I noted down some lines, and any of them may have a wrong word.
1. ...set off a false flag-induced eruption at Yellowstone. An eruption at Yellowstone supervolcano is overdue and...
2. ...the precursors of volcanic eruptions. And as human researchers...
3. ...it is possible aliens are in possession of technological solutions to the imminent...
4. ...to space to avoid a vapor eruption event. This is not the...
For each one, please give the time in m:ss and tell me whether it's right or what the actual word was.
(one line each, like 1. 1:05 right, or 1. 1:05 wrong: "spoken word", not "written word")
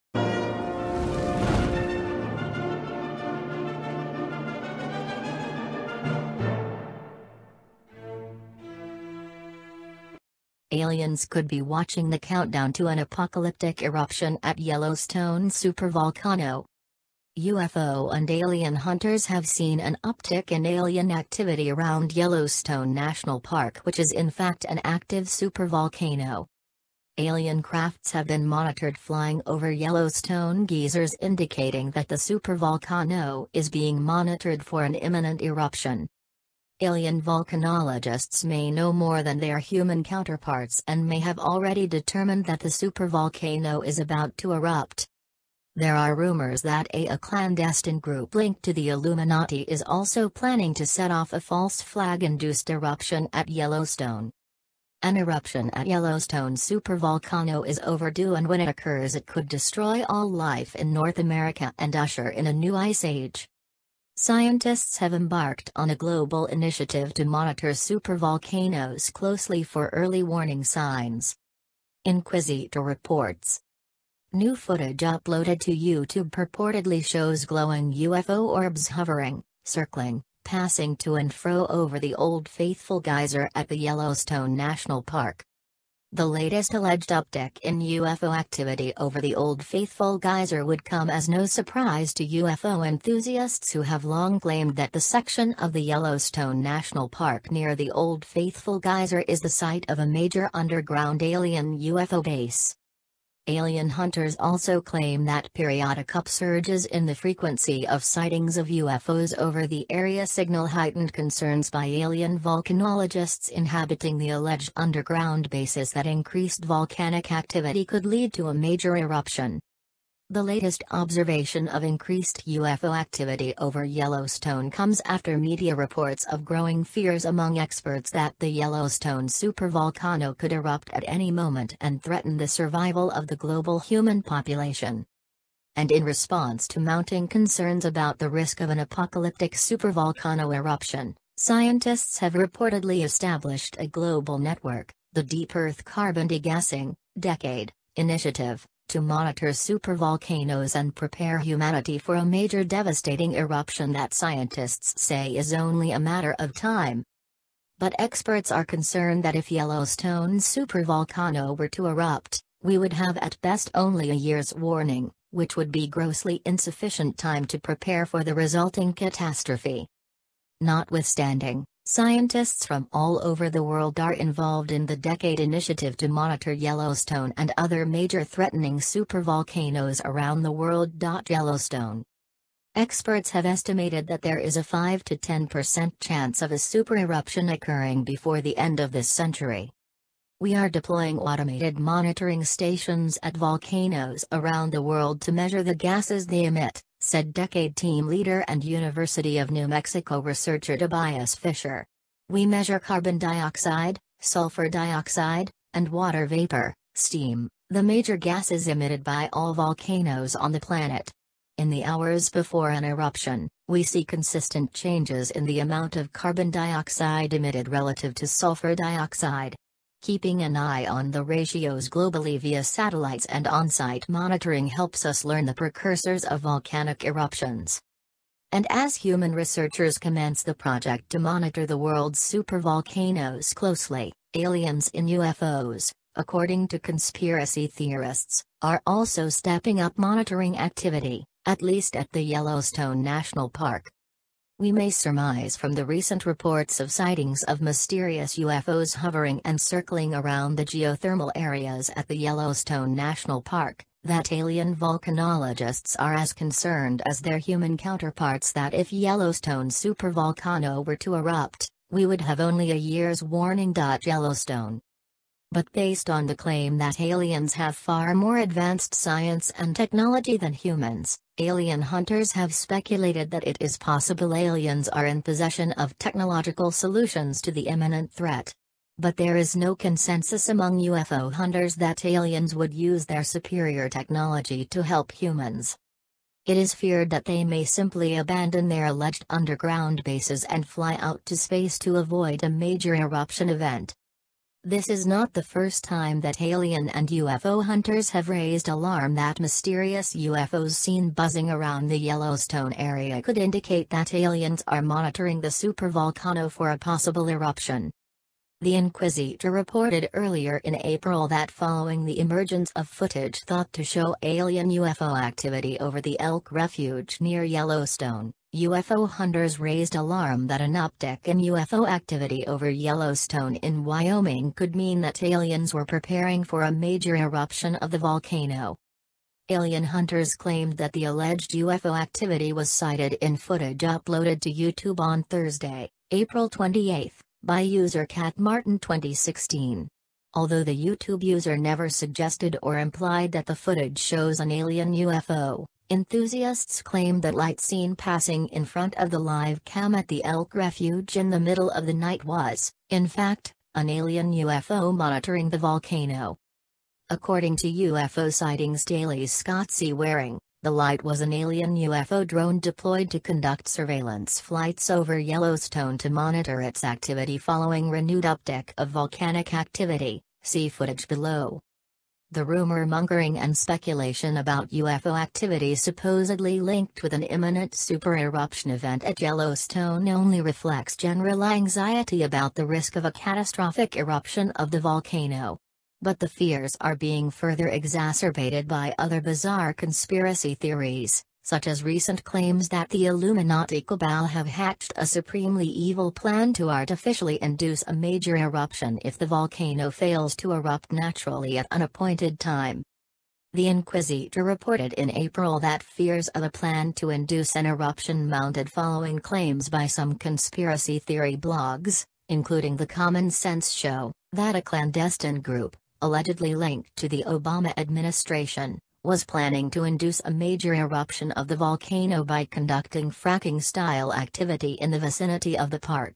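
1. 0:50 right
2. 3:45 right
3. 4:33 right
4. 4:51 wrong: "major", not "vapor".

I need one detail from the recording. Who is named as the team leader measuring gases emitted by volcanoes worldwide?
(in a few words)
Tobias Fischer.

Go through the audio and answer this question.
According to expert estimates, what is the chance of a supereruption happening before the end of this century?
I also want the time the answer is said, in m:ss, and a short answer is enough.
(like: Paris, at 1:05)
5 to 10%, at 3:04.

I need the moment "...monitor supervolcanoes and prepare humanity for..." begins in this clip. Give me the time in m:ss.
2:28.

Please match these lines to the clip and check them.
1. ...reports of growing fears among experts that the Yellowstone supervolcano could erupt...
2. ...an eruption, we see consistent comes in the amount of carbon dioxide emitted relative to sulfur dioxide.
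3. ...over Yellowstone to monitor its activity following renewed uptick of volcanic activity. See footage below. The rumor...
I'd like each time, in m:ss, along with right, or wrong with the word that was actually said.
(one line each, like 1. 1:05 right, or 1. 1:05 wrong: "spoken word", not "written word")
1. 2:05 right
2. 3:32 wrong: "changes", not "comes"
3. 6:04 right.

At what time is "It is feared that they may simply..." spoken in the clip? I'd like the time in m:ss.
4:46.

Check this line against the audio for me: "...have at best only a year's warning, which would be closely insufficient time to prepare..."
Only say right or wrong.
wrong.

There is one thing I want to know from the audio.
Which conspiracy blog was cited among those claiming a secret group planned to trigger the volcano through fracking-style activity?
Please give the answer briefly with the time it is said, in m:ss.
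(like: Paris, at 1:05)
The Common Sense Show, at 6:52.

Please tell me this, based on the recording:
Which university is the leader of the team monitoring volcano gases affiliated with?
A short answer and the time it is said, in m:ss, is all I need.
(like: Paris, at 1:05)
University of New Mexico, at 3:18.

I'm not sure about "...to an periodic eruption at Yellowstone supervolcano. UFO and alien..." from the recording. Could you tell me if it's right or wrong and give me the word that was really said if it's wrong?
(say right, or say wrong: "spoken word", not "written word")
wrong: "apocalyptic", not "periodic".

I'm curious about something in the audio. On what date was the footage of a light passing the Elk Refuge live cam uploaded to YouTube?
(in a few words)
April 28.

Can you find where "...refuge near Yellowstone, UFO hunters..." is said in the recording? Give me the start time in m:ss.
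5:16.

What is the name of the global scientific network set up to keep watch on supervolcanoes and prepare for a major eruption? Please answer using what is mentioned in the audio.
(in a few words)
Deep Earth Carbon Degassing Decade Initiative.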